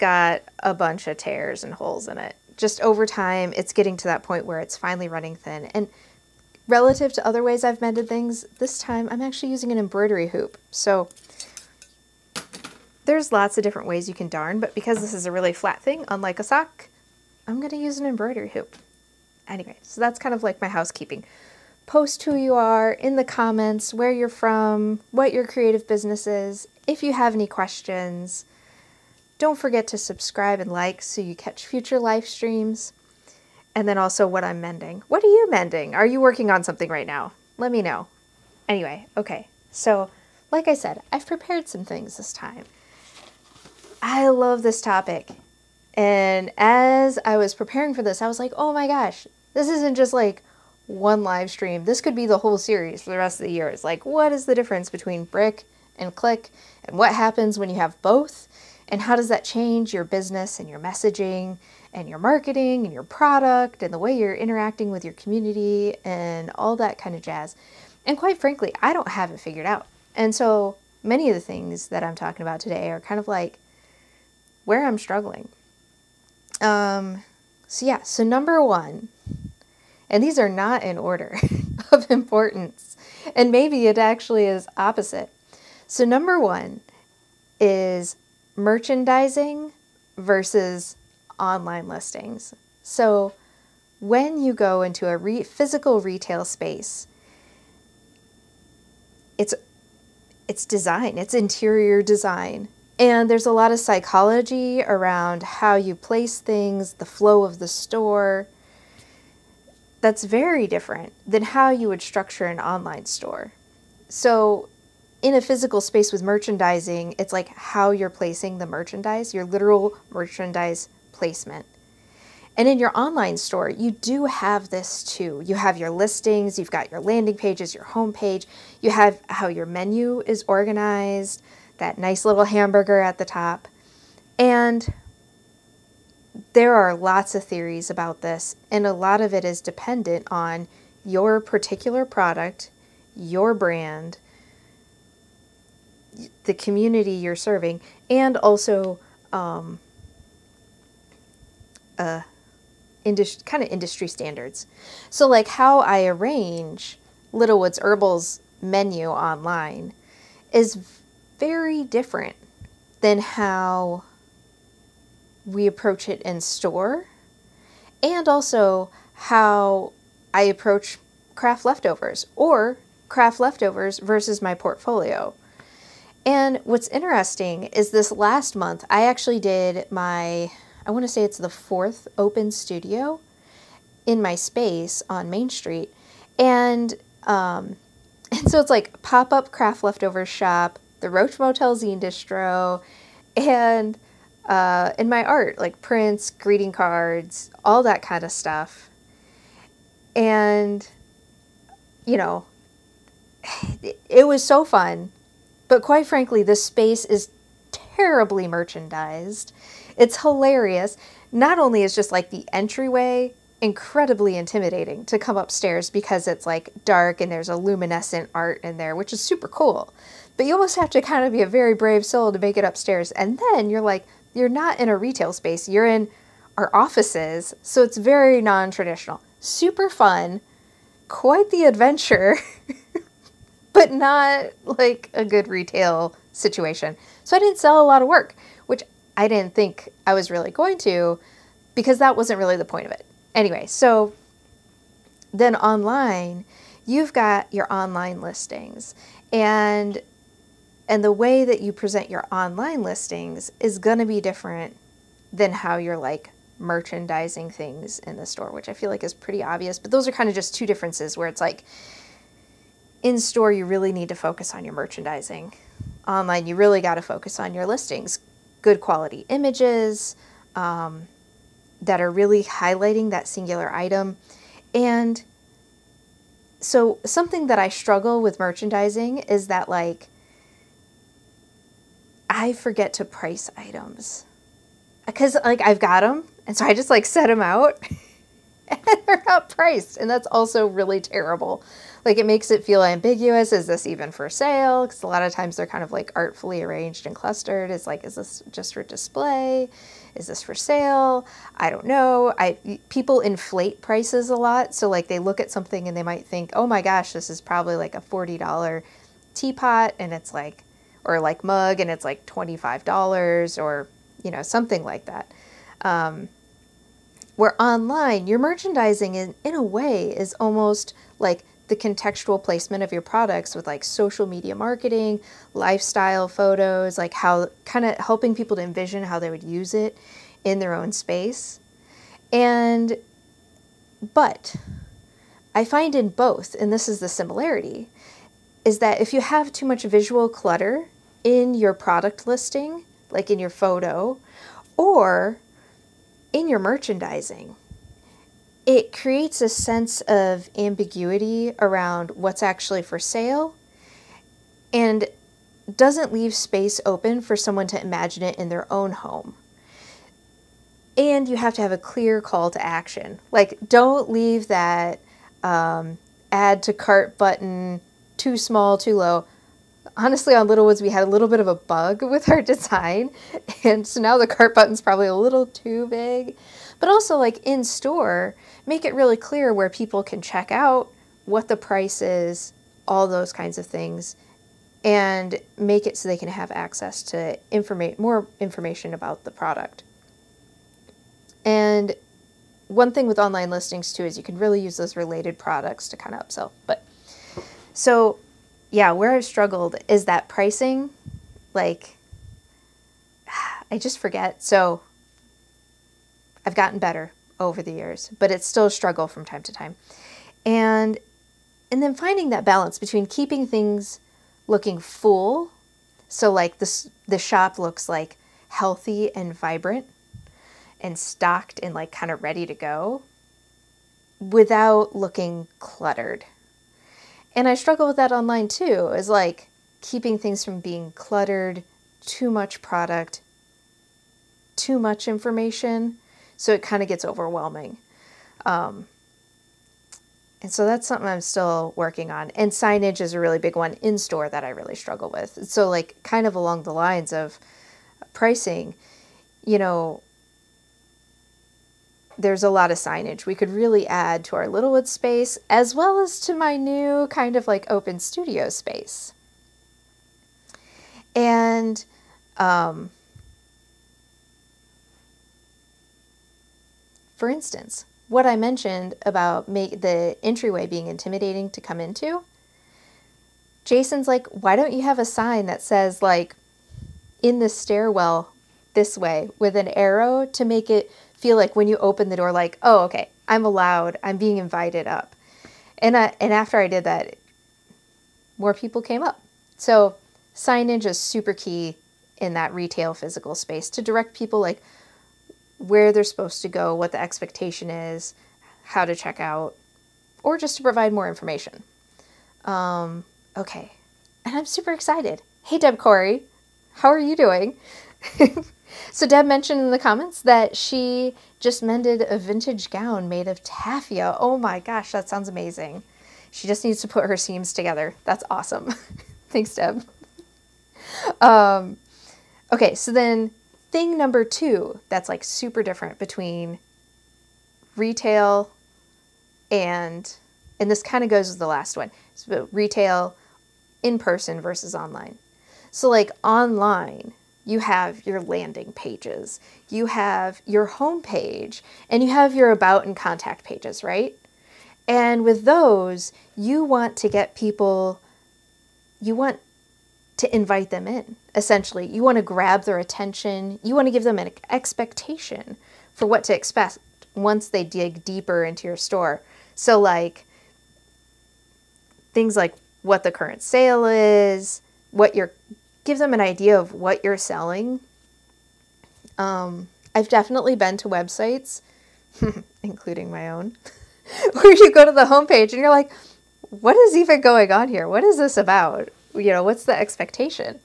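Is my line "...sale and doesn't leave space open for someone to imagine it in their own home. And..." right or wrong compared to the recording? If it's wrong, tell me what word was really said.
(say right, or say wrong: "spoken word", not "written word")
right.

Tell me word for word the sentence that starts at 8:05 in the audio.
And, I, and after I did that, more people came up.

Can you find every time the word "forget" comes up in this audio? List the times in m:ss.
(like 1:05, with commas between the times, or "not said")
0:29, 4:42, 6:43.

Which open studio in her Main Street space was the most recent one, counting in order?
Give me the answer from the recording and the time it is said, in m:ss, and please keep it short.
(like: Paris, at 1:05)
fourth, at 3:01.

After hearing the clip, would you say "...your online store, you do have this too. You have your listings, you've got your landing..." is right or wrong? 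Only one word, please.
right.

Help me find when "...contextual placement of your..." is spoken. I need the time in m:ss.
5:21.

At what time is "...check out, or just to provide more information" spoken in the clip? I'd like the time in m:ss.
8:18.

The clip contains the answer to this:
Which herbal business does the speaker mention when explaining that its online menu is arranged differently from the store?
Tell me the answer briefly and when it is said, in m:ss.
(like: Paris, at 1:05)
Littlewood's Herbals, at 2:37.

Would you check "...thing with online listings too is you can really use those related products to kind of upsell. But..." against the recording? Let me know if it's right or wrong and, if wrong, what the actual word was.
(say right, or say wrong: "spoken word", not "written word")
right.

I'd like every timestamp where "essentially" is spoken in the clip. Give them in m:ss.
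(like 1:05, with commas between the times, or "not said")
9:11.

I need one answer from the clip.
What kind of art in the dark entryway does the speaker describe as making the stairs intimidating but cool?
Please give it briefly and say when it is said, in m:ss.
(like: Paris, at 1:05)
luminescent art, at 3:37.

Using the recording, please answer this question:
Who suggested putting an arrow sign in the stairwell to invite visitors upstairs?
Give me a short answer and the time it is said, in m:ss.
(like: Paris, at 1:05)
Jason, at 7:53.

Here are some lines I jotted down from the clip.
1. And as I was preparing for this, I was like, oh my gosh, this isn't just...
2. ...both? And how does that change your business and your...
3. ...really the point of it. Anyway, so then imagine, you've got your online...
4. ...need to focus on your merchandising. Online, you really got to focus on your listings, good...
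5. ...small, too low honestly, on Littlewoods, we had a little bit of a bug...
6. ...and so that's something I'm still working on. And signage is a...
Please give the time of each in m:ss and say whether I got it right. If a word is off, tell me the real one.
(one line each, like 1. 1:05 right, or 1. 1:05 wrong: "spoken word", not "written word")
1. 0:45 right
2. 0:58 right
3. 4:02 wrong: "online", not "imagine"
4. 4:23 right
5. 6:08 right
6. 7:20 right.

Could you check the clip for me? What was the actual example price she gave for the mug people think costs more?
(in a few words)
$25.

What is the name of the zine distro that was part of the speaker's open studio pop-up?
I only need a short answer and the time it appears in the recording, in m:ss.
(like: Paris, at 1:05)
Roach Motel, at 3:11.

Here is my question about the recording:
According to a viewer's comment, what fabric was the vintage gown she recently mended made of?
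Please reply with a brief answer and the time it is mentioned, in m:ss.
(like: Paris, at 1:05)
taffeta, at 8:33.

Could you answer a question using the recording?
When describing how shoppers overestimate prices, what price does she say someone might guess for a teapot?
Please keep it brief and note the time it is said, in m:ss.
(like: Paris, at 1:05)
$40, at 5:08.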